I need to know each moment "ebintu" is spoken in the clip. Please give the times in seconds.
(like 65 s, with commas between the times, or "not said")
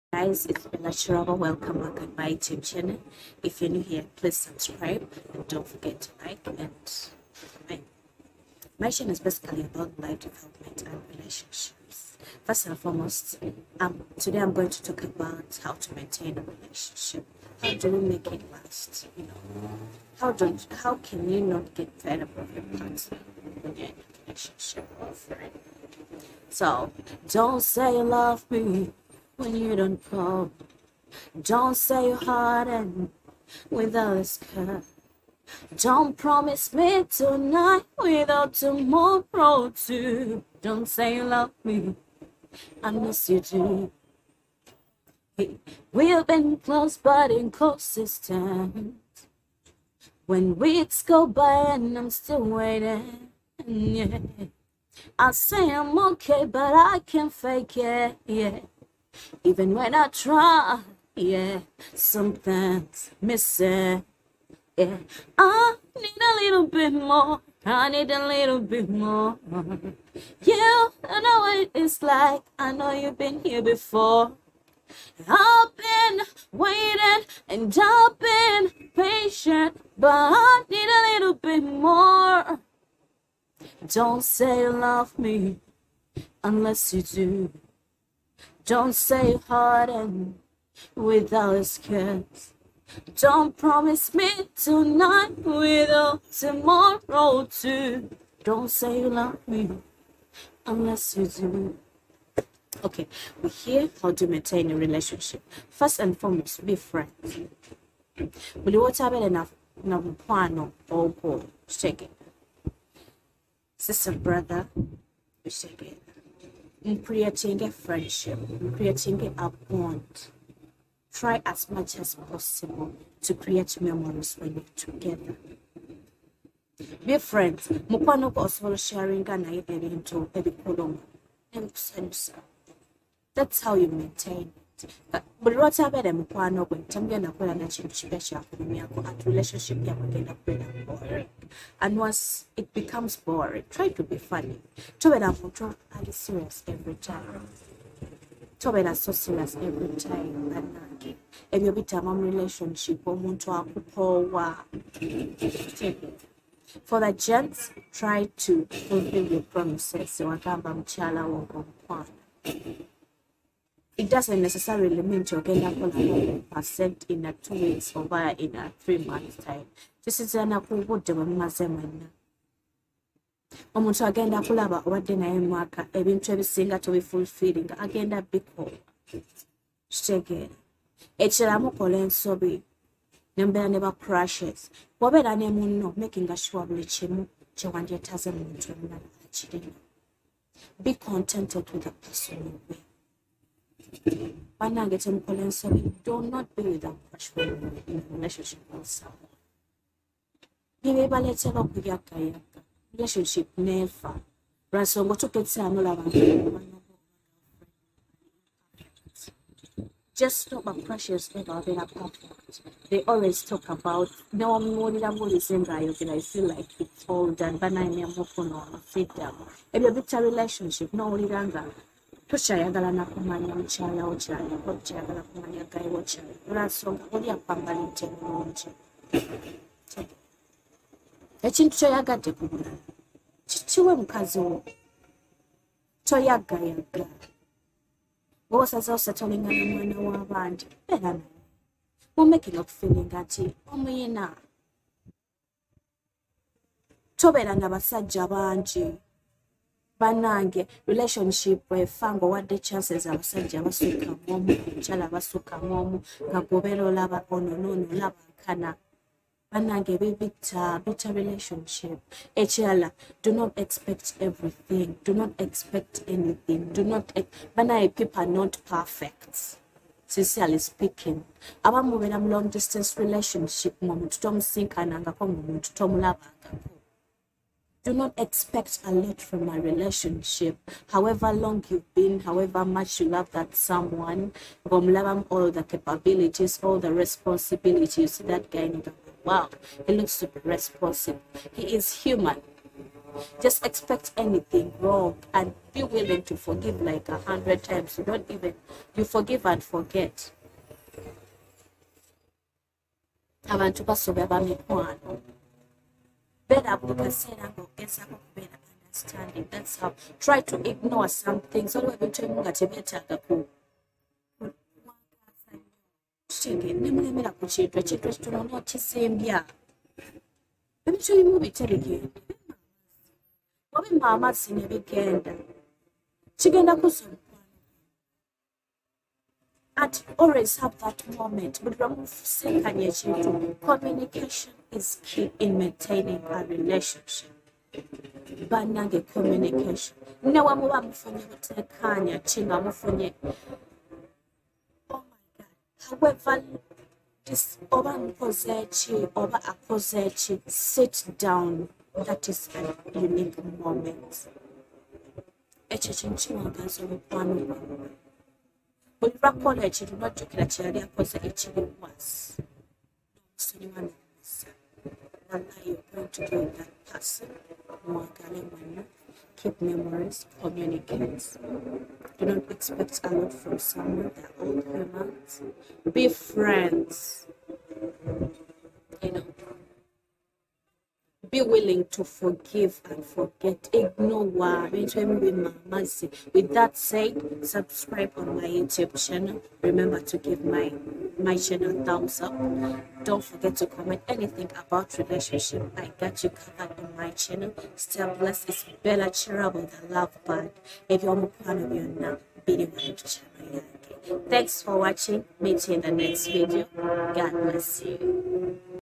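175 s, 311 s, 320 s.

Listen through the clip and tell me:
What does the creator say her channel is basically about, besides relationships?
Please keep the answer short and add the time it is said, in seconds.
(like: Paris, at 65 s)
life development, at 9 s.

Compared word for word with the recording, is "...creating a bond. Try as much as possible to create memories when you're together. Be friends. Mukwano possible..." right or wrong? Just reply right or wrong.
right.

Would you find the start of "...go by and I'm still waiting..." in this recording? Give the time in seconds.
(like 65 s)
51 s.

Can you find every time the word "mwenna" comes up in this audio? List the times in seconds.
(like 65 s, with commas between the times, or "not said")
171 s, 368 s.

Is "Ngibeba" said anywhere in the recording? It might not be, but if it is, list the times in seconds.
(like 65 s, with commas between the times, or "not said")
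200 s.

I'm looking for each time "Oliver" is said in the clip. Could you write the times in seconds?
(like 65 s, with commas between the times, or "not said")
359 s.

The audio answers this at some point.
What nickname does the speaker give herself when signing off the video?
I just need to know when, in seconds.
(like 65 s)
399 s.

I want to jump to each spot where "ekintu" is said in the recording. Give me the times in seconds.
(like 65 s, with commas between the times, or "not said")
231 s, 317 s.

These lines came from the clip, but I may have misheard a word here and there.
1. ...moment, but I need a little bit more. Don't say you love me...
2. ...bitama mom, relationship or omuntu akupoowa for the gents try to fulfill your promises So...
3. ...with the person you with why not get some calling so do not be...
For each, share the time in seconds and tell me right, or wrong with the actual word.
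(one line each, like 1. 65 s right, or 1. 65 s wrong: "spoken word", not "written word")
1. 78 s wrong: "patient", not "moment"
2. 151 s right
3. 191 s right.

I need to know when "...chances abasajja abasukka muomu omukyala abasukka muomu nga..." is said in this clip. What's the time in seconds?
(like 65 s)
252 s.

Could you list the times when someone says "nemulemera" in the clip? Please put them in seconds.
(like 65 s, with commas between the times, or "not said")
316 s.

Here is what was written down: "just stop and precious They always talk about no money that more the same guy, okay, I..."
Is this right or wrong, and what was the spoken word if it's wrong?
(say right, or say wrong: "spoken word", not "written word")
right.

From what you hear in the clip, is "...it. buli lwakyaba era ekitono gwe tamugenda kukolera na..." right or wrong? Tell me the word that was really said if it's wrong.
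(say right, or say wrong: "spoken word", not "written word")
wrong: "mukwano", not "ekitono".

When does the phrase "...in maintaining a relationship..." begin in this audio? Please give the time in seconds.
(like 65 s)
335 s.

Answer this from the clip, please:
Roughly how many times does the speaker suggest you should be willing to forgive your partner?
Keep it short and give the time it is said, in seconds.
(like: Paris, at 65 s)
100, at 297 s.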